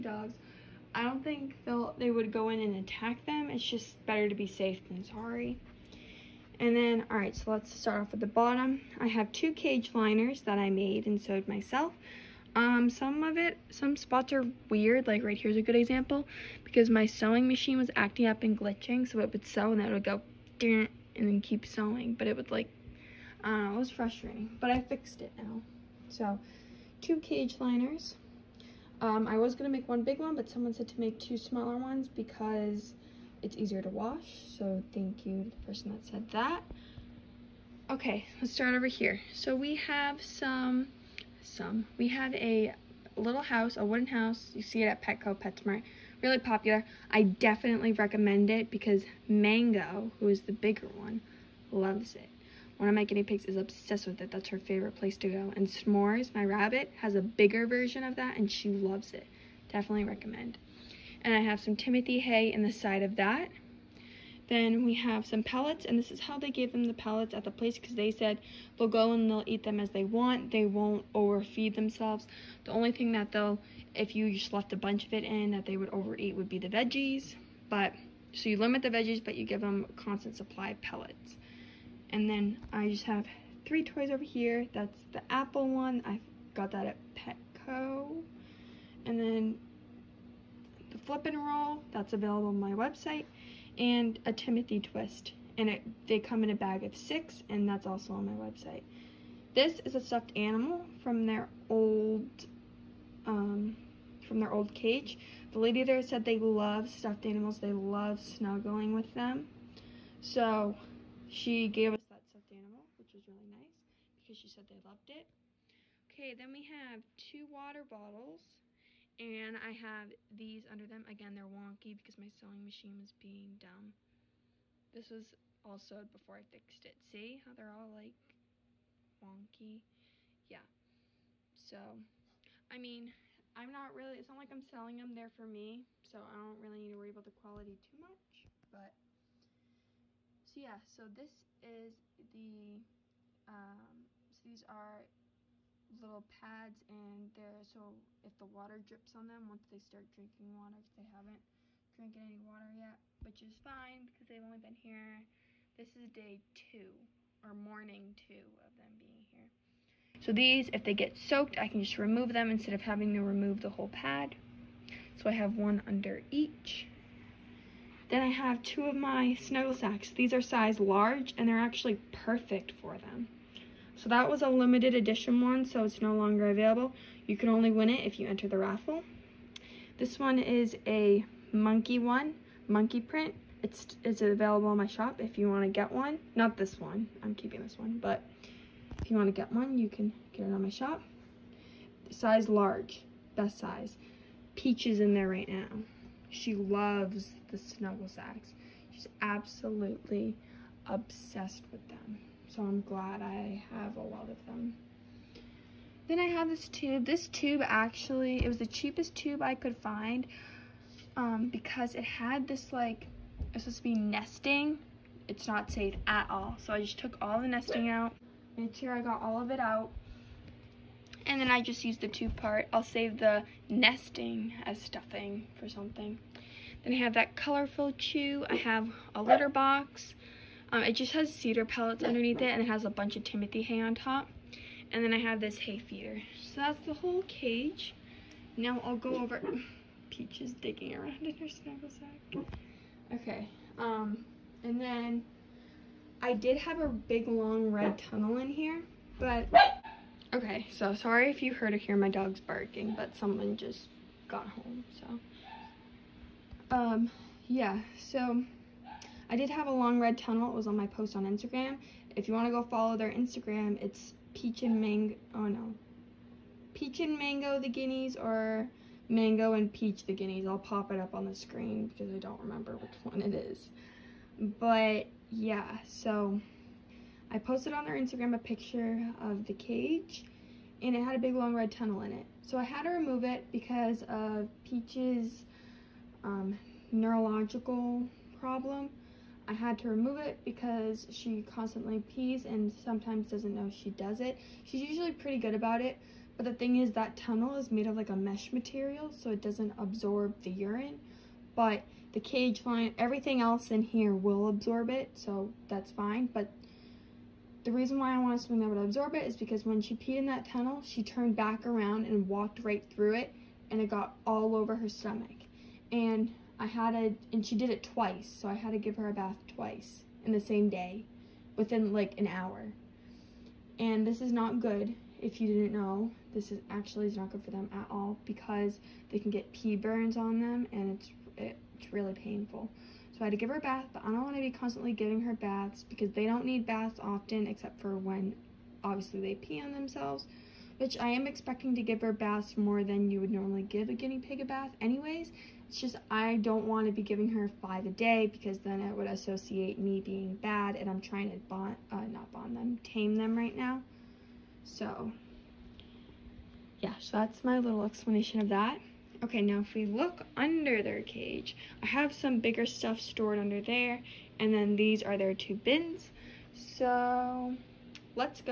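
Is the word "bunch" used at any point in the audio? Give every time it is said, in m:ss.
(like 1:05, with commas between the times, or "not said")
1:14, 3:52.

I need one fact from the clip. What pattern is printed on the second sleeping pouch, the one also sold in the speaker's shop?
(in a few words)
Monkey print.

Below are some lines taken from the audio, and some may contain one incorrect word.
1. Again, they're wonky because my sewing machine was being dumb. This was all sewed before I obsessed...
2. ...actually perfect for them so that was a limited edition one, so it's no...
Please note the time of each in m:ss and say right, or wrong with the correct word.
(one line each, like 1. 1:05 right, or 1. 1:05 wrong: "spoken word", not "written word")
1. 2:01 wrong: "fixed", not "obsessed"
2. 2:51 right.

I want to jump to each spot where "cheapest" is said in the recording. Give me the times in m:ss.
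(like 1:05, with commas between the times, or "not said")
3:28.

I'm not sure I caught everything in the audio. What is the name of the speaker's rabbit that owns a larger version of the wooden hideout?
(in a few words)
S'mores.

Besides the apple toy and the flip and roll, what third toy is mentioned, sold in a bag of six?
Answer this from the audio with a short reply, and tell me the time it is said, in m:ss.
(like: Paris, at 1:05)
Timothy twist, at 1:34.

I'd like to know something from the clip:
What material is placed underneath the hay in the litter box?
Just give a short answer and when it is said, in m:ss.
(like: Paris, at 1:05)
Cedar pellets, at 3:51.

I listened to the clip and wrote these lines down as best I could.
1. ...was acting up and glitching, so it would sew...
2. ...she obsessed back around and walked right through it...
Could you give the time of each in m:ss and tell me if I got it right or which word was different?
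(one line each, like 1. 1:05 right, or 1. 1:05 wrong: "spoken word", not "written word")
1. 0:17 right
2. 5:10 wrong: "turned", not "obsessed".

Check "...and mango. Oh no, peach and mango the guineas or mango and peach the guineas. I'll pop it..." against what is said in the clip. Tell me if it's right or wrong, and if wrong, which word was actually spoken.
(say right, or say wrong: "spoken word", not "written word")
right.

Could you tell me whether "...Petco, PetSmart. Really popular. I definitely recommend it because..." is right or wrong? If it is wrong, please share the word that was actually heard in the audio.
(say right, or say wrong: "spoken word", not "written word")
right.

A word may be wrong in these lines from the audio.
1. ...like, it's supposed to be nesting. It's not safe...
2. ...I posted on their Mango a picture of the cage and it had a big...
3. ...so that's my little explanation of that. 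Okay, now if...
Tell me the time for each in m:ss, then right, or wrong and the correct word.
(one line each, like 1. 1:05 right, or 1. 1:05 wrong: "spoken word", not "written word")
1. 3:32 right
2. 4:37 wrong: "Instagram", not "Mango"
3. 5:56 right.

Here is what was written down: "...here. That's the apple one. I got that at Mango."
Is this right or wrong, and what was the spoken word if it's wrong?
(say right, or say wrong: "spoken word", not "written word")
wrong: "Petco", not "Mango".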